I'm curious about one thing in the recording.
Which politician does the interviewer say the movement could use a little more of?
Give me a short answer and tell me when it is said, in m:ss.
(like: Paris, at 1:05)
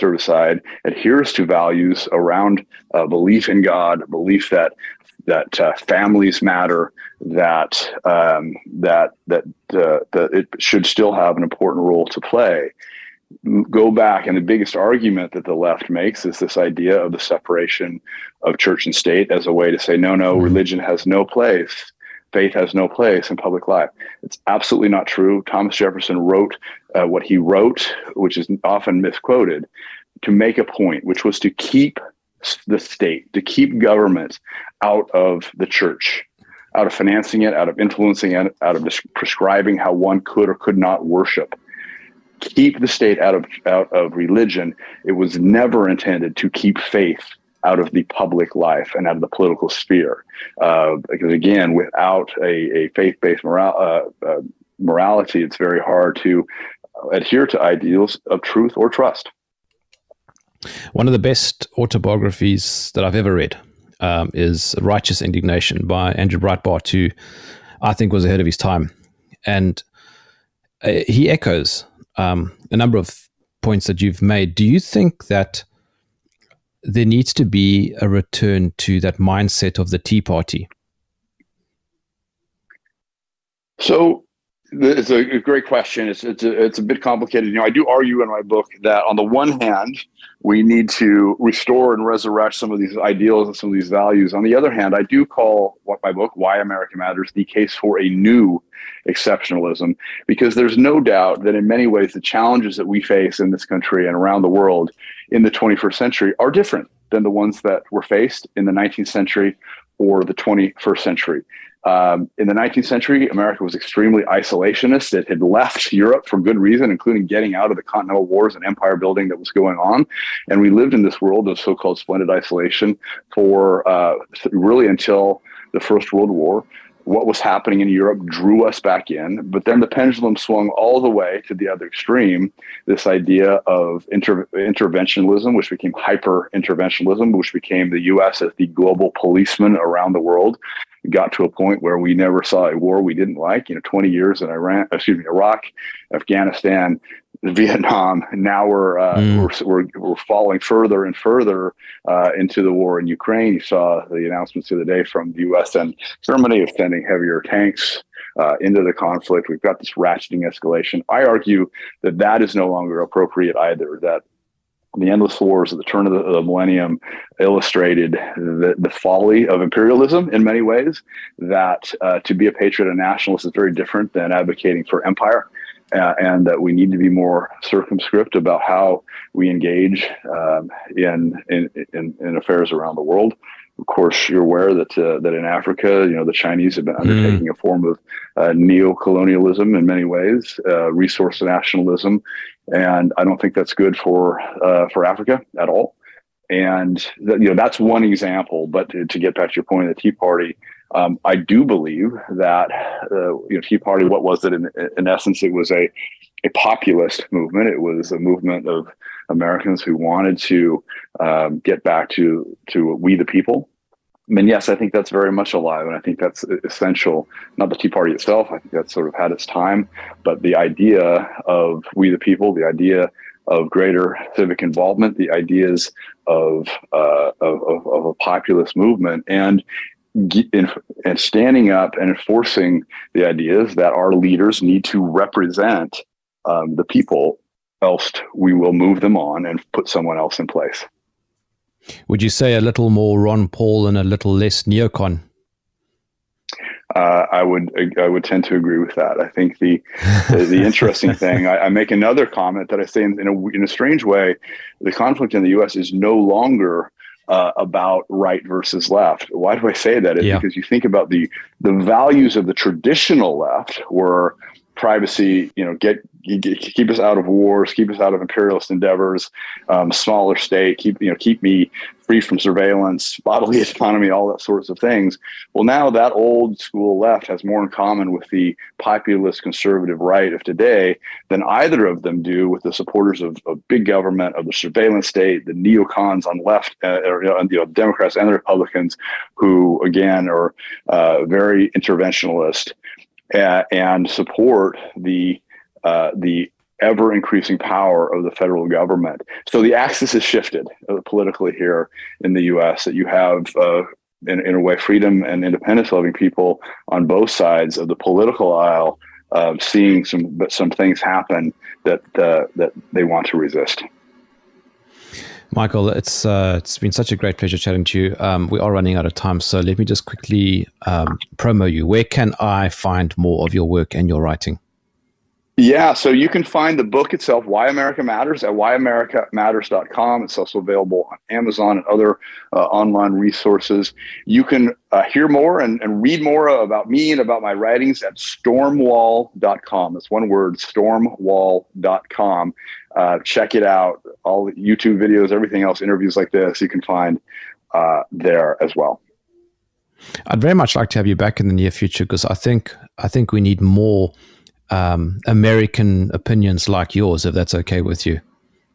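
Ron Paul, at 4:03.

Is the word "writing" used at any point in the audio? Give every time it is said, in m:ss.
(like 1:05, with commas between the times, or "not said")
5:24, 5:37.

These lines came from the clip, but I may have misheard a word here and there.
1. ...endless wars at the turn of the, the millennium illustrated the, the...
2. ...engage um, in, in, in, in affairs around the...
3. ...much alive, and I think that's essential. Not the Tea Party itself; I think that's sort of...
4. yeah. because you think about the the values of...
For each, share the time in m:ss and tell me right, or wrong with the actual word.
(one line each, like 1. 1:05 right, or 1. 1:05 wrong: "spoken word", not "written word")
1. 2:45 right
2. 2:59 right
3. 3:35 right
4. 4:20 right.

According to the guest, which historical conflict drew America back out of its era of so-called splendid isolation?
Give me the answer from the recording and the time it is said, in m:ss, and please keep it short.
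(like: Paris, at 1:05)
First World War, at 2:05.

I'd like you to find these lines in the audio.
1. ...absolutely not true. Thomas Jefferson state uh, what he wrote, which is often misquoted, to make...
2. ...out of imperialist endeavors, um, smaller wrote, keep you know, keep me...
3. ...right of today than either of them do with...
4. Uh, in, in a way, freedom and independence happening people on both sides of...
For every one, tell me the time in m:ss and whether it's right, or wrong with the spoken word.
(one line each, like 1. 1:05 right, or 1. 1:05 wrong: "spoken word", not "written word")
1. 0:24 wrong: "wrote", not "state"
2. 4:28 wrong: "state", not "wrote"
3. 4:40 right
4. 5:03 wrong: "loving", not "happening".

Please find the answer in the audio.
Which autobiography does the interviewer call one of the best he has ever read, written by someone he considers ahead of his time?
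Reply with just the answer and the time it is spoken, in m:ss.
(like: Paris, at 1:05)
Righteous Indignation, at 1:04.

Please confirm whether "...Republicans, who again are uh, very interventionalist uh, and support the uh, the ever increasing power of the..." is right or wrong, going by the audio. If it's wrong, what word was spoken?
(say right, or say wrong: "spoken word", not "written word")
right.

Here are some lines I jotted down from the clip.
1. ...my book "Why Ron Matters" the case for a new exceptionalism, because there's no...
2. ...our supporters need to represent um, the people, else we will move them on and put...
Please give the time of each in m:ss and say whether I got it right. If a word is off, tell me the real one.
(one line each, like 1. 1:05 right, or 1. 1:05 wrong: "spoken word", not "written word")
1. 1:36 wrong: "America", not "Ron"
2. 3:53 wrong: "leaders", not "supporters".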